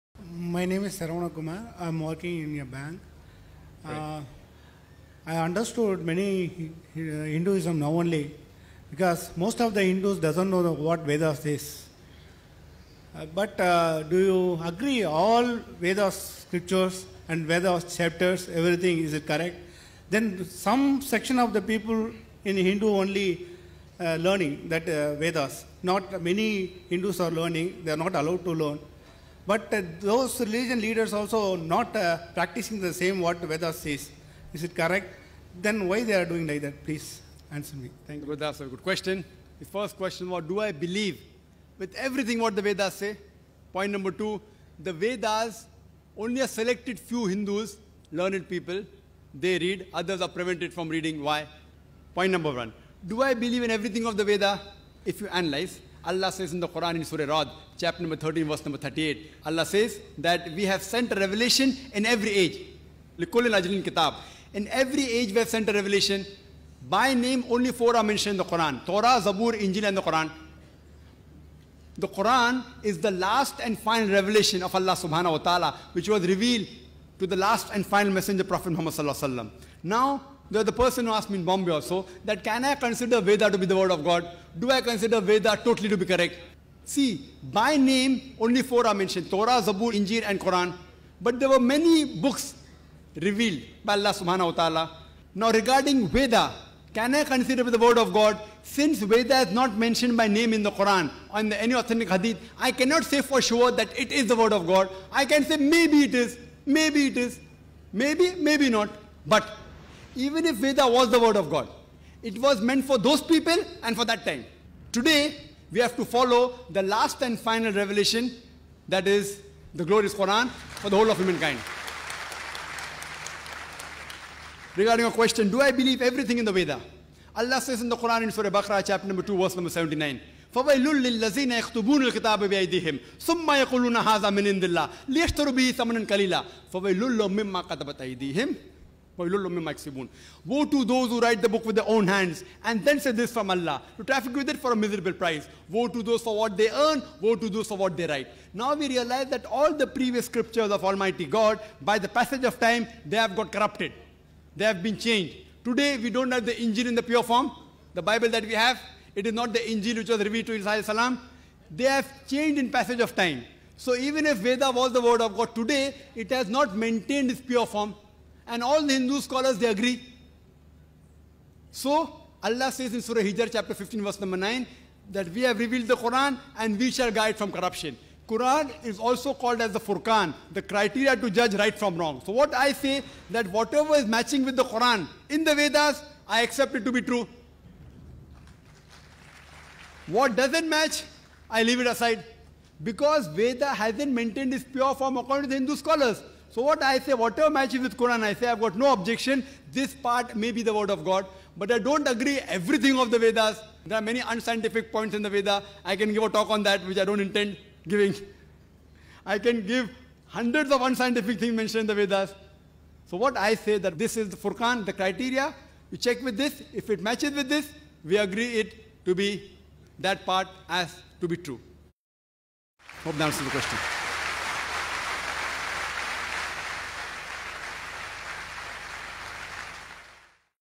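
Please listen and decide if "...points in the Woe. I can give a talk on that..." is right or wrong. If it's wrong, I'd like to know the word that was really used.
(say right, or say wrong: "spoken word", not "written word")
wrong: "Veda", not "Woe".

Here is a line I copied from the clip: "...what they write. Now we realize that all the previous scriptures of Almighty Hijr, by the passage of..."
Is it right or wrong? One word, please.
wrong.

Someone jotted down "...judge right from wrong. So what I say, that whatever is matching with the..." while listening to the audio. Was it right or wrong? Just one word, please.
right.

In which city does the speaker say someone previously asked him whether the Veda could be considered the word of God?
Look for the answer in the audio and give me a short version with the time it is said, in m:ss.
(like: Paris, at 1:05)
Bombay, at 1:21.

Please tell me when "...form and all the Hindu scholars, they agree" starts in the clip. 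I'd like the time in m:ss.
2:47.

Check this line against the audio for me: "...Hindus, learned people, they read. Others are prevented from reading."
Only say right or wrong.
right.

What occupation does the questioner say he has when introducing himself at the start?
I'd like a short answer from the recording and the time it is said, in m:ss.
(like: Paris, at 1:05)
Working in a bank, at 0:02.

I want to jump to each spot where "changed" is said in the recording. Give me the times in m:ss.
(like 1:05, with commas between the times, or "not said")
2:34, 2:42.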